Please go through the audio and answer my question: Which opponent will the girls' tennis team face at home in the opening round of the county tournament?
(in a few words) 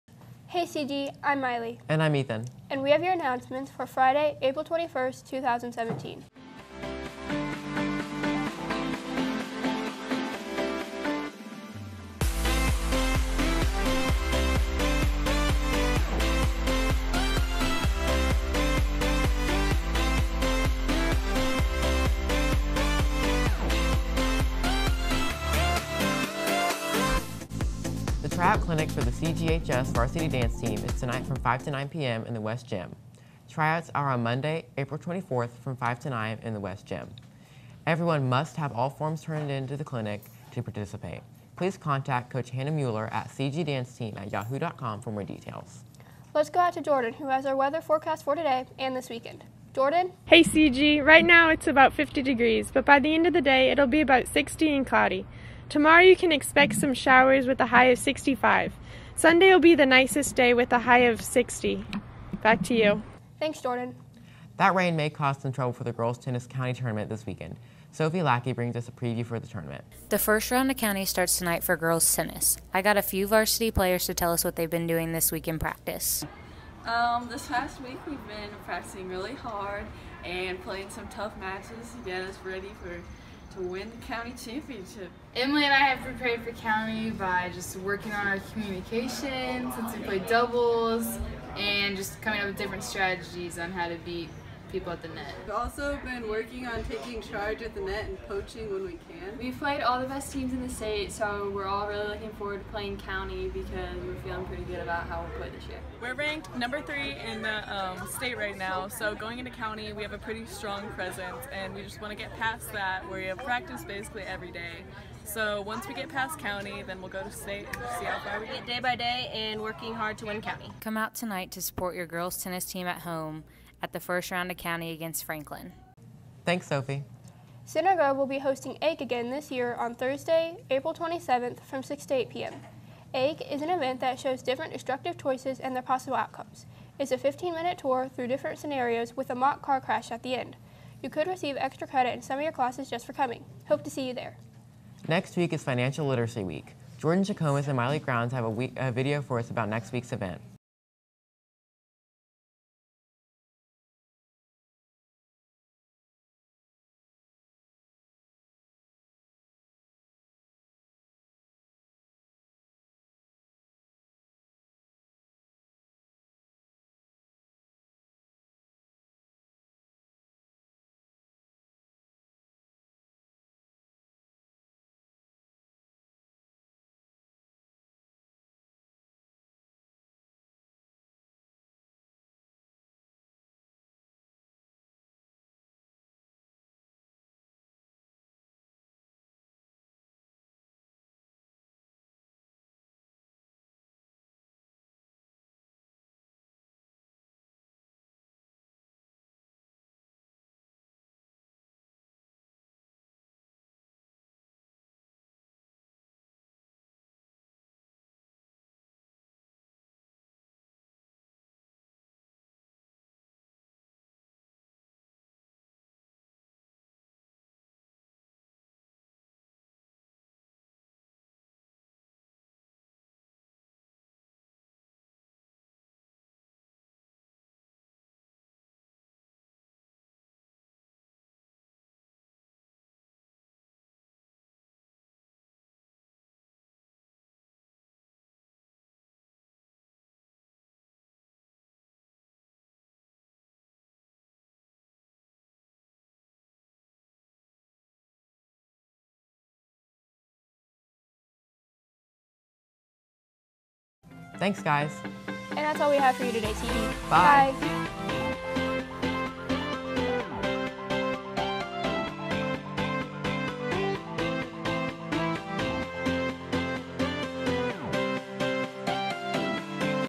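Franklin.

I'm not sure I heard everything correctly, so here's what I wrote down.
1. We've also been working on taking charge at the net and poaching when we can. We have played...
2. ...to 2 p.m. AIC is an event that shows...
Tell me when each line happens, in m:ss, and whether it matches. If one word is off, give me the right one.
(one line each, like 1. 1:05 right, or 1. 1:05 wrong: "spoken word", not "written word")
1. 1:35 right
2. 2:12 wrong: "8", not "2".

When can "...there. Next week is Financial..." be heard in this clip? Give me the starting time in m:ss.
2:24.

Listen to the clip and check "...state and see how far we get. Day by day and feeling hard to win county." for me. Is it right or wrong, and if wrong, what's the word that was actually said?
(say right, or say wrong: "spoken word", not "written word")
wrong: "working", not "feeling".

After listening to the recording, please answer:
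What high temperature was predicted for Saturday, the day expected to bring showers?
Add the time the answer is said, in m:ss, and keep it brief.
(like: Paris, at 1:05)
65, at 0:57.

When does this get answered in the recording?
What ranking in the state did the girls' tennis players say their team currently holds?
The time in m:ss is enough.
1:46.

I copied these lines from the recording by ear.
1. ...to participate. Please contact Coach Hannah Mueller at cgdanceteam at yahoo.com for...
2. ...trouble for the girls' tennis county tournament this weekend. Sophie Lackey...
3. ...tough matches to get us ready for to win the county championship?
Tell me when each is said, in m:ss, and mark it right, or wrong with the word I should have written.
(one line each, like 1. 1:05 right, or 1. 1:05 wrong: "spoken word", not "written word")
1. 0:40 right
2. 1:05 right
3. 1:21 right.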